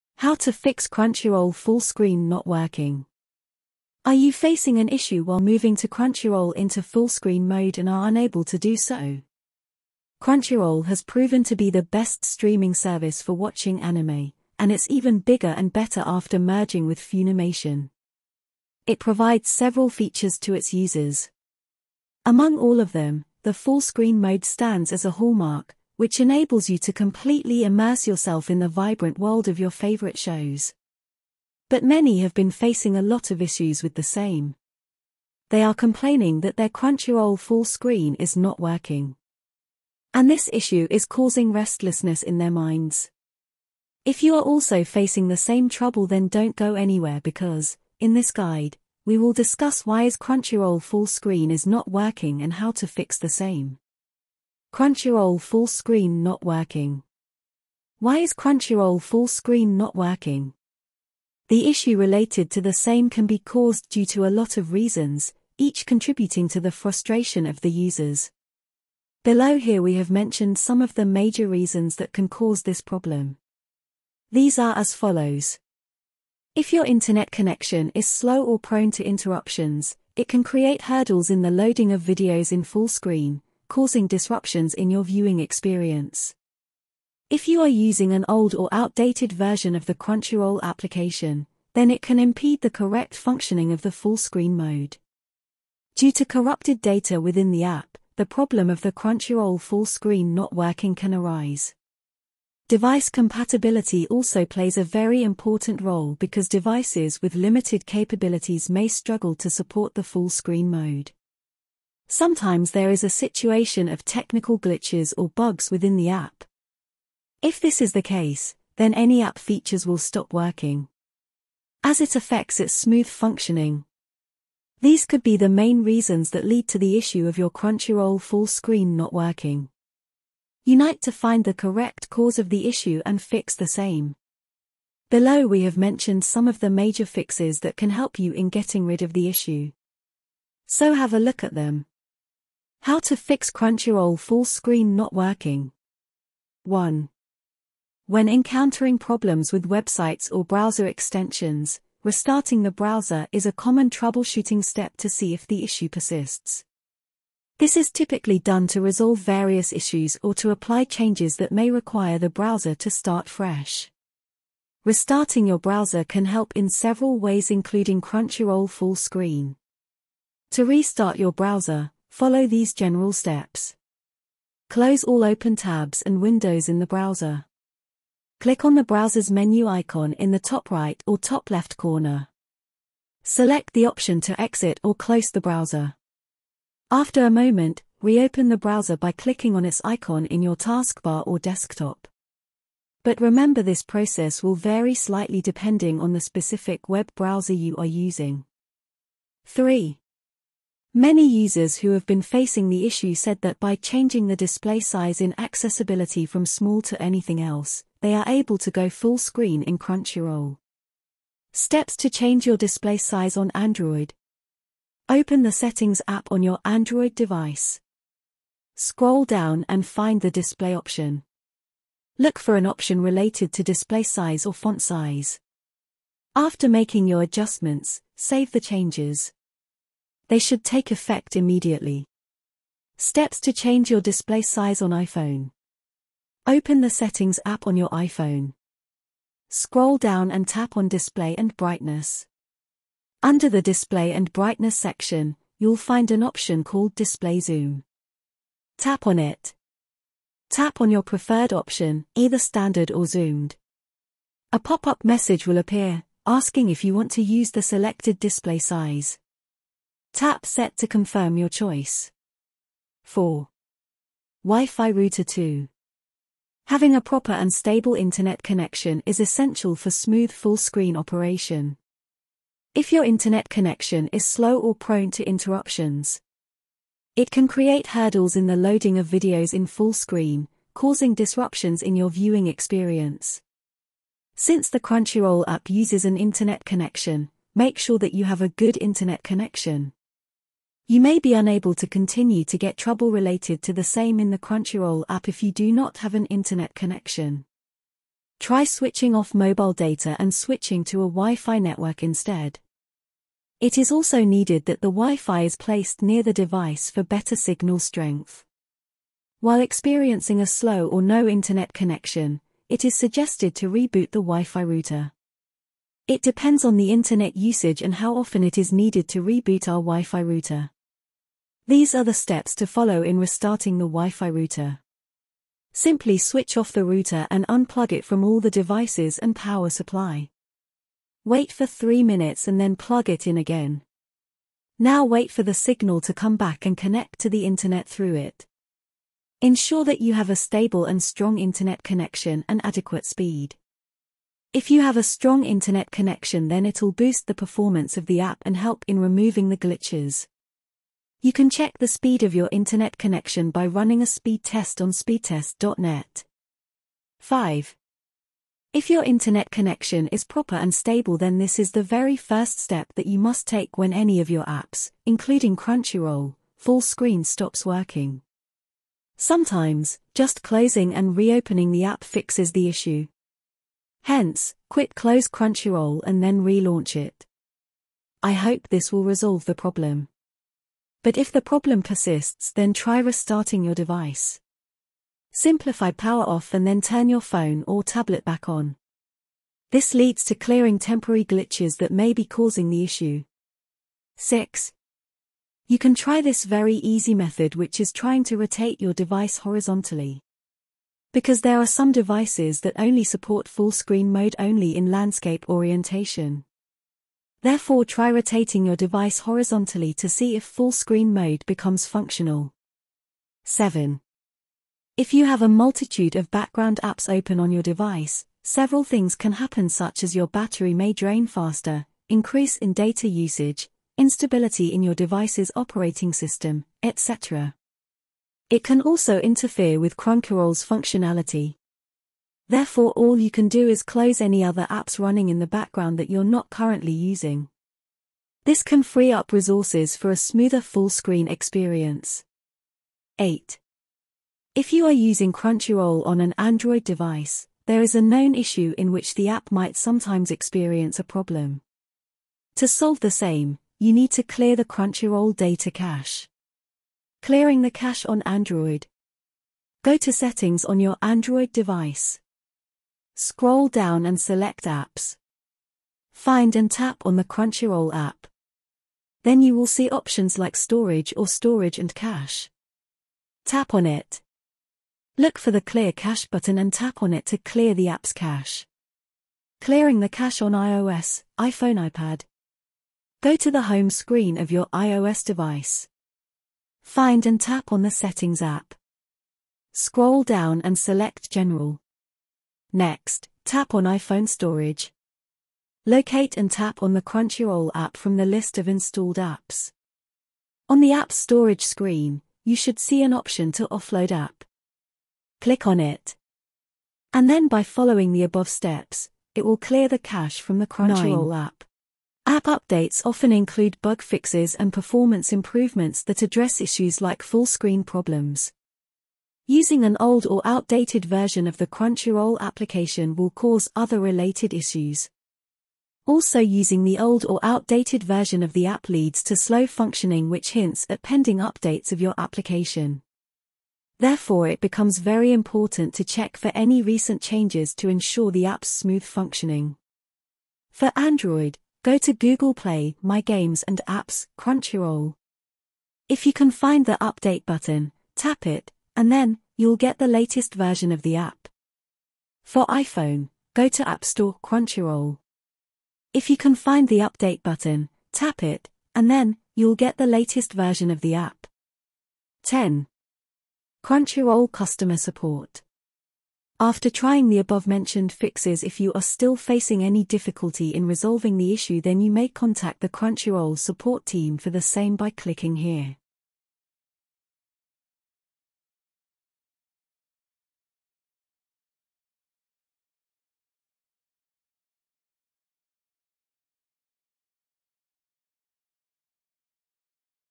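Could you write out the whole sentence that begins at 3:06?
After a moment, reopen the browser by clicking on its icon in your taskbar or desktop.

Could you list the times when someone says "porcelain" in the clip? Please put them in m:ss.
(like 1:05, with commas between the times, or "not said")
not said.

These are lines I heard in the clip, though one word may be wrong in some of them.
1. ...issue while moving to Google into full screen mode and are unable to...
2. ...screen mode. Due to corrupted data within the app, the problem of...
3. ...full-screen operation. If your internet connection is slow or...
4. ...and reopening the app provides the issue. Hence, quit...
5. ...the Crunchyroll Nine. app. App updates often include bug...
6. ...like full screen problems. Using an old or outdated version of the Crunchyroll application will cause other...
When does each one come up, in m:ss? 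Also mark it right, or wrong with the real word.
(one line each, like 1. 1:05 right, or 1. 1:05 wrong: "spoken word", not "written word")
1. 0:04 wrong: "Crunchyroll", not "Google"
2. 1:34 right
3. 4:30 right
4. 6:10 wrong: "fixes", not "provides"
5. 8:30 right
6. 8:37 right.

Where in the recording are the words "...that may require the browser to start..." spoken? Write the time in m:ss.
2:41.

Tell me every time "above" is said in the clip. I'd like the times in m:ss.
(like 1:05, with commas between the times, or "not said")
8:28, 9:27.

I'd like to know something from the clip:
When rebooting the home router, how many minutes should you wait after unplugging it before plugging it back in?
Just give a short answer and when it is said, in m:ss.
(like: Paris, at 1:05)
3 minutes, at 5:31.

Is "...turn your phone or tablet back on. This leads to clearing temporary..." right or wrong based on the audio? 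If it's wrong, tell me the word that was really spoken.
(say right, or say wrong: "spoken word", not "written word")
right.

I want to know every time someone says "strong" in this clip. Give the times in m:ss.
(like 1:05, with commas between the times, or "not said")
5:41, 5:45.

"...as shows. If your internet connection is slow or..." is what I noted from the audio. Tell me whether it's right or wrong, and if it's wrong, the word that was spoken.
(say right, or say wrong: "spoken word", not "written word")
wrong: "follows", not "shows".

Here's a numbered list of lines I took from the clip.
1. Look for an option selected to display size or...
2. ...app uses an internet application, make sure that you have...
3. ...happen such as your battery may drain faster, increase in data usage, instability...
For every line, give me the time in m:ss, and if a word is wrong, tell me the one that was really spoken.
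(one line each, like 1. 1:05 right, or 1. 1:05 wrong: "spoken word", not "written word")
1. 3:42 wrong: "related", not "selected"
2. 4:45 wrong: "connection", not "application"
3. 6:59 right.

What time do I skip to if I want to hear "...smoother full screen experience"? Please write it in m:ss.
7:20.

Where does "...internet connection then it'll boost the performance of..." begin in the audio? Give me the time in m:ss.
5:45.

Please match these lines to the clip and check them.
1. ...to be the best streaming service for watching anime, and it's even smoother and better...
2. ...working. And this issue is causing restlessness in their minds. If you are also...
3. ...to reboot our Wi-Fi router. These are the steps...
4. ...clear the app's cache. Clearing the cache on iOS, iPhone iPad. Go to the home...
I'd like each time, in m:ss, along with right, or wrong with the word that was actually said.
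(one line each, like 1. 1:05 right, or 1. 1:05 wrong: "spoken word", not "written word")
1. 0:11 wrong: "bigger", not "smoother"
2. 0:38 right
3. 5:19 right
4. 7:57 right.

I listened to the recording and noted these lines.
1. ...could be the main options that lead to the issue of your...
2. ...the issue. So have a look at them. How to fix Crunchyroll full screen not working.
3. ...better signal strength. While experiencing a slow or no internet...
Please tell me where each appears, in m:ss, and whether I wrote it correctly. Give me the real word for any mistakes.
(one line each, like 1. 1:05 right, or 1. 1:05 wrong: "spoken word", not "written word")
1. 2:05 wrong: "reasons", not "options"
2. 2:19 right
3. 5:07 right.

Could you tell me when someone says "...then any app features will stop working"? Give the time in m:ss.
1:58.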